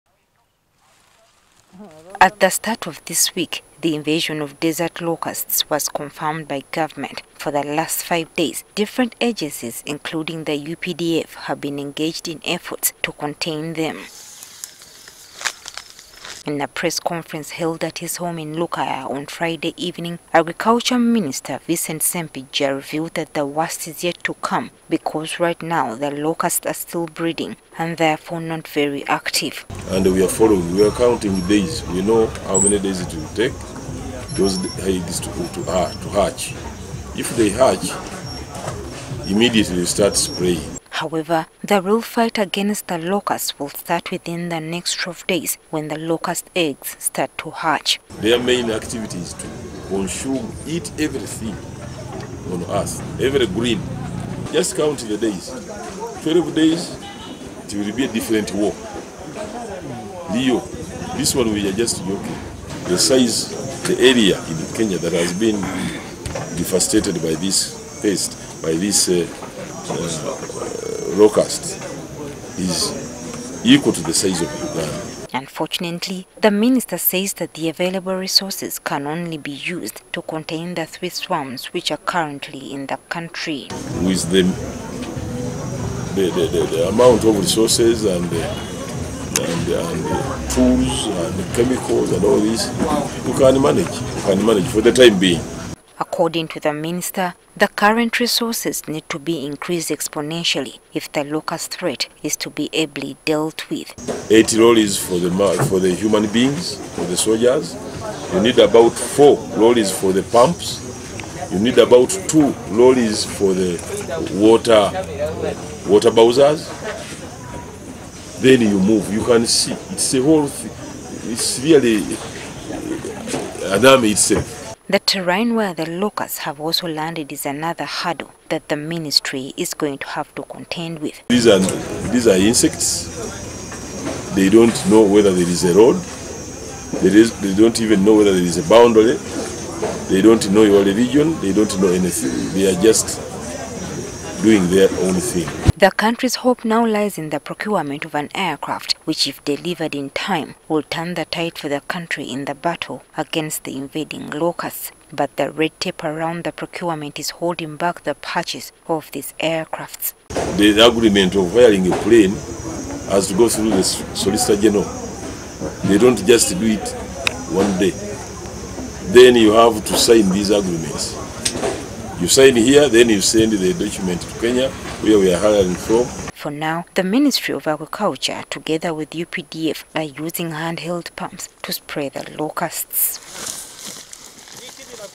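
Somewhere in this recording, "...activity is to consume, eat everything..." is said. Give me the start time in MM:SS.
00:48.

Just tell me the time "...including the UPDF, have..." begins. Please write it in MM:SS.
00:09.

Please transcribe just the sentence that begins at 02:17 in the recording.
They, is, they don't even know whether there is a boundary.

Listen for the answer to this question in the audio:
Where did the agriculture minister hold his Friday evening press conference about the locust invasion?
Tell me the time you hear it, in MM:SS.
00:18.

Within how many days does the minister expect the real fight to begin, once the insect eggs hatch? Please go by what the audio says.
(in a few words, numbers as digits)
12 days.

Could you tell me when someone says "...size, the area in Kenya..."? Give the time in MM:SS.
01:02.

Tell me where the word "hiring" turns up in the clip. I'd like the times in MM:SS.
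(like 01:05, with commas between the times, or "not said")
02:41, 02:55.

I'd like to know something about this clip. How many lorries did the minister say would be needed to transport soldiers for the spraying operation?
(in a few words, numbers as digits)
80.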